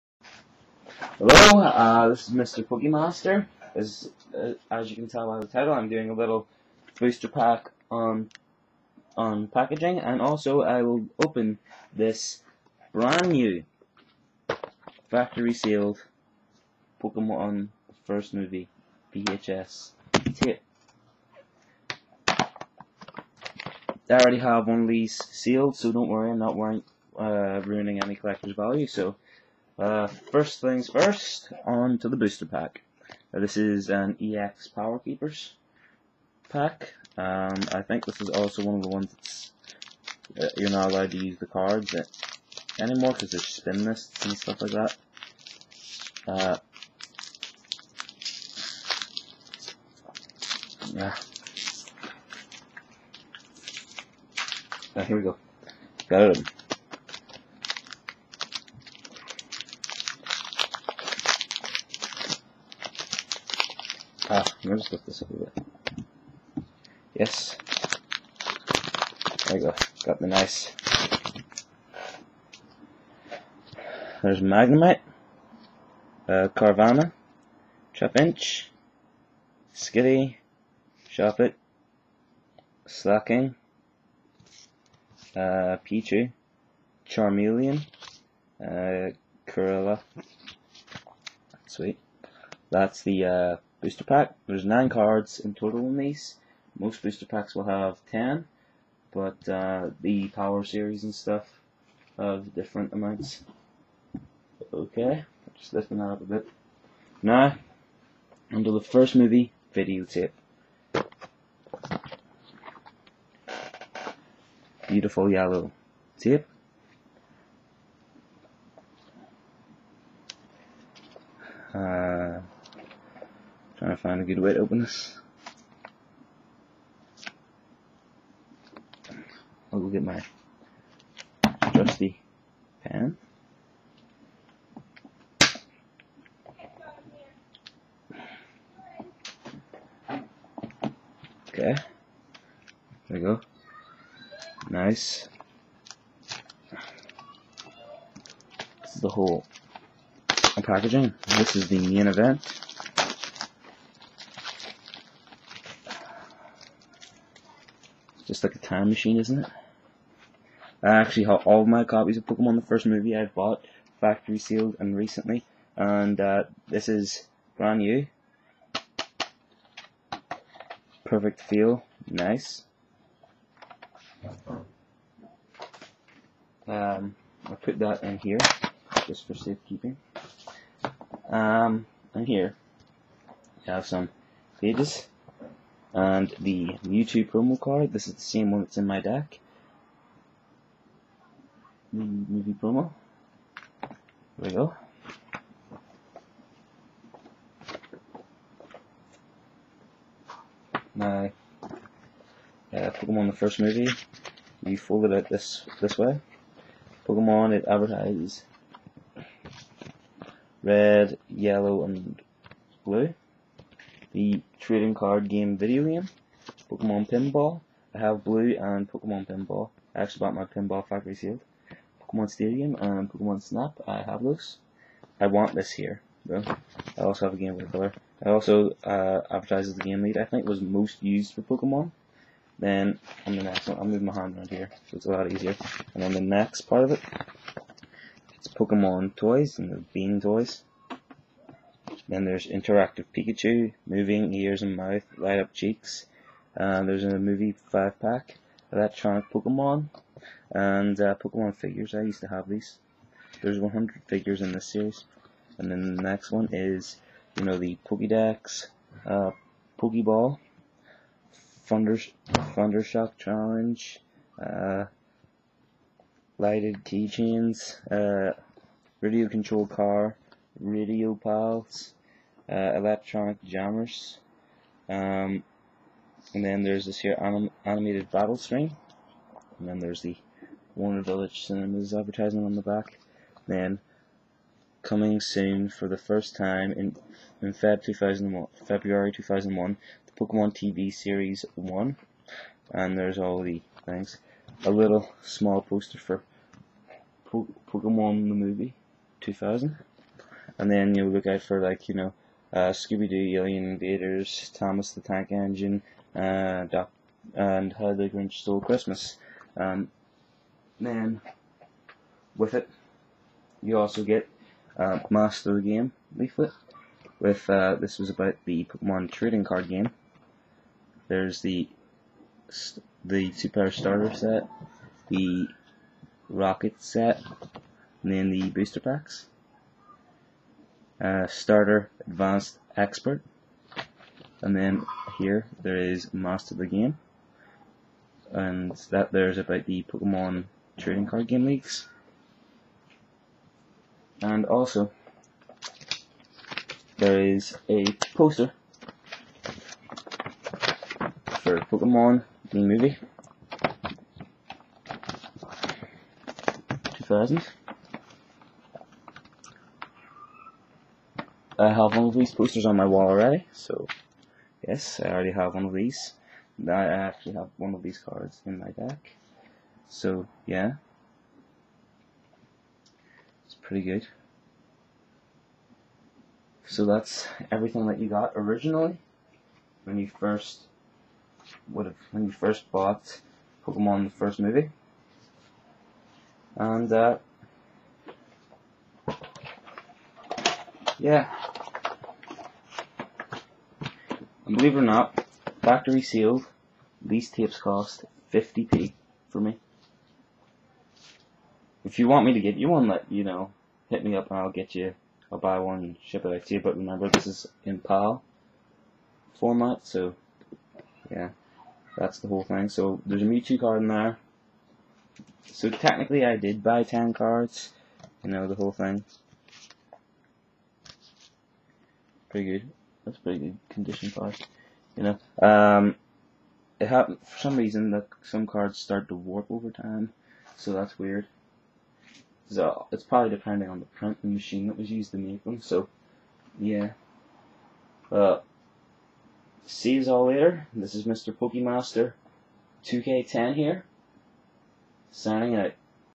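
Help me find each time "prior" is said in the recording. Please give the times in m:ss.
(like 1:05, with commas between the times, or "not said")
not said.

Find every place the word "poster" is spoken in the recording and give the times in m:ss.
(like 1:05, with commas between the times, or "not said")
4:55, 5:48, 6:02.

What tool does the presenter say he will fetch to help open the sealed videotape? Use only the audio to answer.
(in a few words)
pan.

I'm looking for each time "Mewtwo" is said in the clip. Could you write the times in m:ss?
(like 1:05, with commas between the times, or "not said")
3:06, 6:53.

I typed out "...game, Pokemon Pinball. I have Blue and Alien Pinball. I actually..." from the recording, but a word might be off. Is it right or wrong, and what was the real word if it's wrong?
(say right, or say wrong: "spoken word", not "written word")
wrong: "Pokemon", not "Alien".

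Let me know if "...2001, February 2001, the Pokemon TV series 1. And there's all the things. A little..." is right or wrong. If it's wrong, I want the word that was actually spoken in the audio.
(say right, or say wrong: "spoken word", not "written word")
right.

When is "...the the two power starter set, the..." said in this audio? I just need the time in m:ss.
5:21.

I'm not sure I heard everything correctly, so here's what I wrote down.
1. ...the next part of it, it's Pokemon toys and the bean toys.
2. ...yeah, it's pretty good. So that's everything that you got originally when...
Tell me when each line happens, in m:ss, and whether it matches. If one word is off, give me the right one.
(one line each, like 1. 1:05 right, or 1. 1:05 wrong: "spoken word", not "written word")
1. 3:56 right
2. 6:10 right.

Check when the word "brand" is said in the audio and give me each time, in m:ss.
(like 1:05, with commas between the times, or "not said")
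0:12, 2:47.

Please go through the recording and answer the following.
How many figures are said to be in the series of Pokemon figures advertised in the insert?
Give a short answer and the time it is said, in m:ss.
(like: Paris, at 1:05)
100, at 4:13.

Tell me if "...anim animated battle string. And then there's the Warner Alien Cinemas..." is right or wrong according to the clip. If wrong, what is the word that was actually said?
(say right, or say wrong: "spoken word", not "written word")
wrong: "Village", not "Alien".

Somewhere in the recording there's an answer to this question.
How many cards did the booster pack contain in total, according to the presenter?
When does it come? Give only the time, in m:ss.
1:34.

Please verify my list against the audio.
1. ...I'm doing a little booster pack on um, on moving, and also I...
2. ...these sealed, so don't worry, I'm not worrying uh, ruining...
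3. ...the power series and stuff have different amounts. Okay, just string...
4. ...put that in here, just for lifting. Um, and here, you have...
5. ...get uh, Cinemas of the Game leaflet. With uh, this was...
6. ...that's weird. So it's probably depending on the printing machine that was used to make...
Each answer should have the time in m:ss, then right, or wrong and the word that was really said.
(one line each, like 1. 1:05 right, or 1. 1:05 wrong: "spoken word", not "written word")
1. 0:05 wrong: "packaging", not "moving"
2. 0:24 right
3. 1:39 wrong: "lifting", not "string"
4. 2:57 wrong: "safekeeping", not "lifting"
5. 5:14 wrong: "Master", not "Cinemas"
6. 7:10 right.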